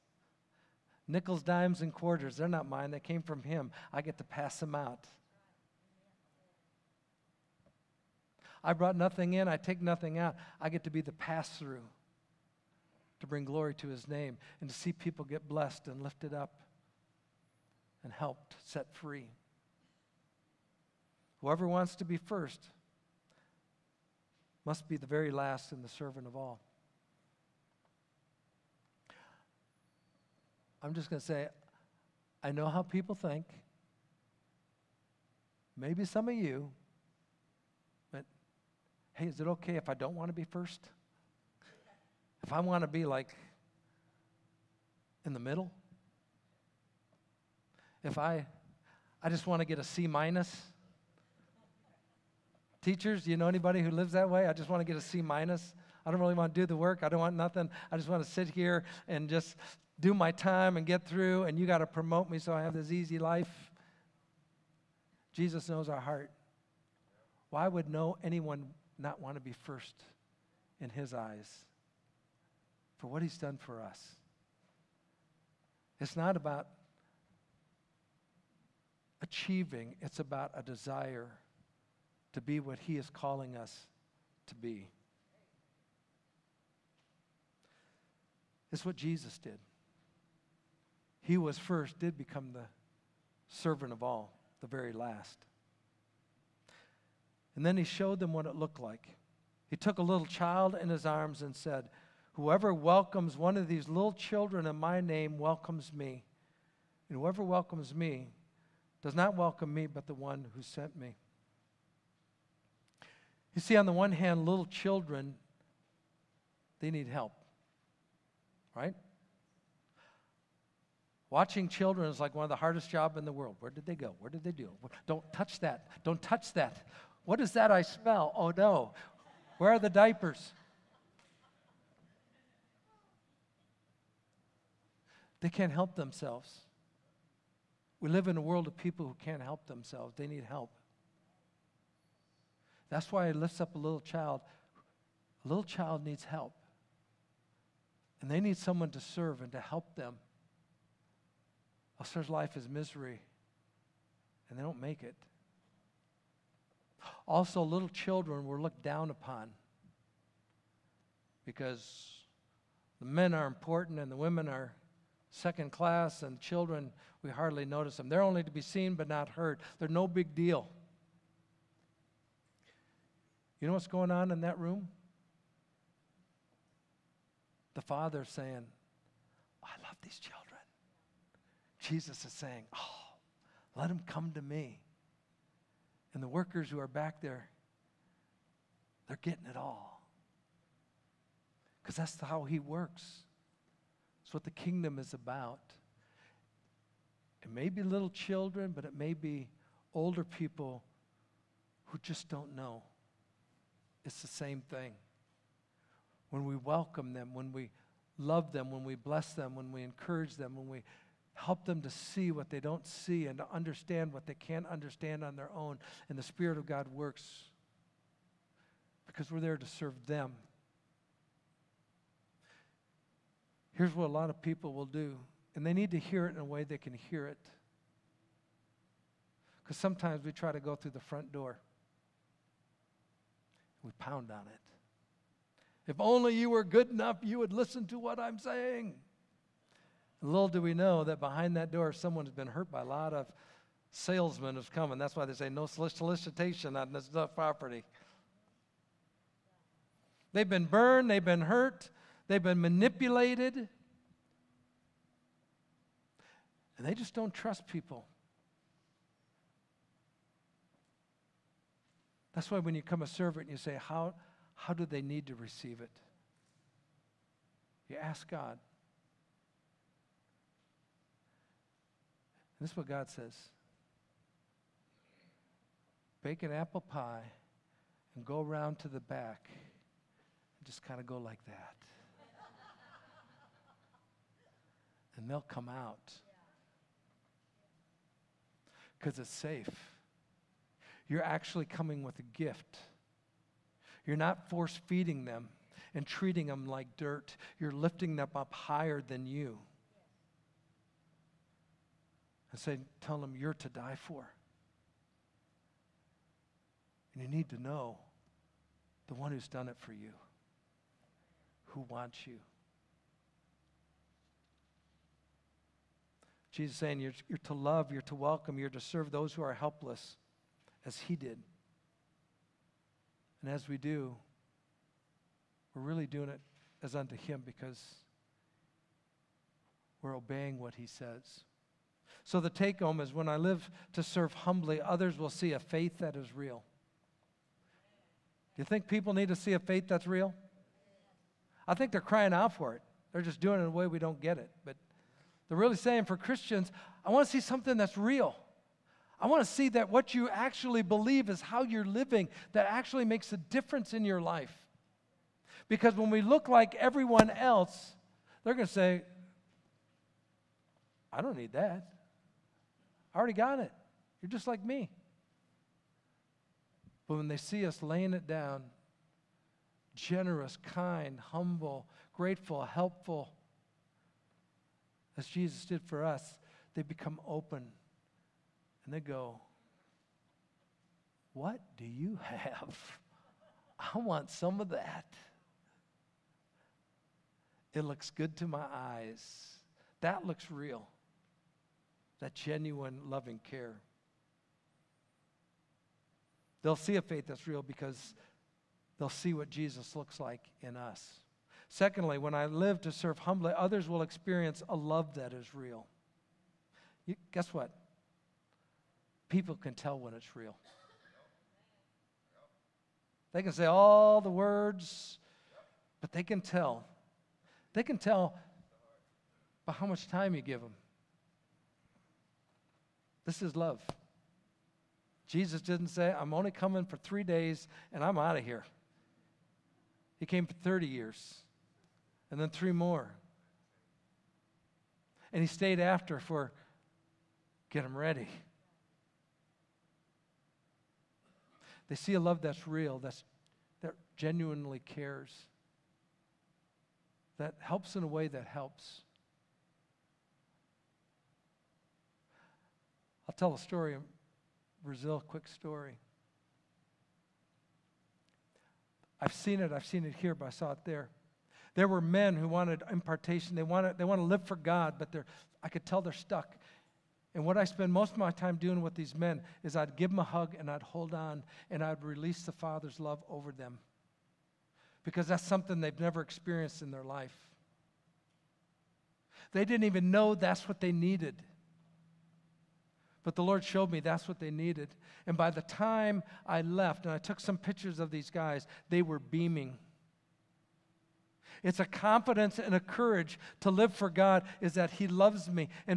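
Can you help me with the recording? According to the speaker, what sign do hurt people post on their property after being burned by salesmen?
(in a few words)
no solicitation.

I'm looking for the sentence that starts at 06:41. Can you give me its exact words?
Secondly, when I live to serve humbly, others will experience a love that is real.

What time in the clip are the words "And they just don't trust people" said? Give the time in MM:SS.
04:16.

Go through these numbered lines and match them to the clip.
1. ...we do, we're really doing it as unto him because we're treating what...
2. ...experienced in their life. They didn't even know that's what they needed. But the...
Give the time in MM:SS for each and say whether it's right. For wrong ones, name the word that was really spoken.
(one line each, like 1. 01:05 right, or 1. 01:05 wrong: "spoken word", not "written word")
1. 05:23 wrong: "obeying", not "treating"
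2. 07:56 right.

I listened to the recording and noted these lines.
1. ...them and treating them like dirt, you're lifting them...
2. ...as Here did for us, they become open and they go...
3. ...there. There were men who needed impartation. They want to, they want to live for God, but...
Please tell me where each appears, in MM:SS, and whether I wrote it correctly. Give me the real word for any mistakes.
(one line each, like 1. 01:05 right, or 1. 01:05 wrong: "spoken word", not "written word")
1. 04:55 right
2. 06:15 wrong: "Jesus", not "Here"
3. 07:40 wrong: "wanted", not "needed".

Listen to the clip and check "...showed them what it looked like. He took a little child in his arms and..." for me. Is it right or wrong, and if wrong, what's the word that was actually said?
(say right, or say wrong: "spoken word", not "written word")
right.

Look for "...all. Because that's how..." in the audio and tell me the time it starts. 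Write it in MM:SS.
03:09.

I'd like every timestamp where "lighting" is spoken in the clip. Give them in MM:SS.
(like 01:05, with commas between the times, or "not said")
not said.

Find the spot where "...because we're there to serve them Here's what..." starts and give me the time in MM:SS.
03:39.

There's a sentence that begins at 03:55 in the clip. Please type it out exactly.
If only you were good enough, you would listen to what I'm saying.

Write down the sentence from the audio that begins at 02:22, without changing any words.
That's why it lifts up a little child.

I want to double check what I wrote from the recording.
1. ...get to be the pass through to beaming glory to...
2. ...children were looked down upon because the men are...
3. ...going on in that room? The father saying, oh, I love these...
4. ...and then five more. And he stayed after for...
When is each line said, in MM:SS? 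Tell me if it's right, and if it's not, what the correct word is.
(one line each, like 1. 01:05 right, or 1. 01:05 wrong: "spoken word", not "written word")
1. 00:10 wrong: "bring", not "beaming"
2. 02:37 right
3. 02:53 right
4. 07:12 wrong: "three", not "five".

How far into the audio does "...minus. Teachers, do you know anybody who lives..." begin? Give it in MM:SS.
00:50.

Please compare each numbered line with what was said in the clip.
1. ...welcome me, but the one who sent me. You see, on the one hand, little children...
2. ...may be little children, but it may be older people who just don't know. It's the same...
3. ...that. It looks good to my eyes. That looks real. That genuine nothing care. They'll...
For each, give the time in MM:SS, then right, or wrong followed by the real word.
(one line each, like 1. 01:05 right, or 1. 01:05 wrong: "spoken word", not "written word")
1. 01:49 right
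2. 03:17 right
3. 06:24 wrong: "loving", not "nothing".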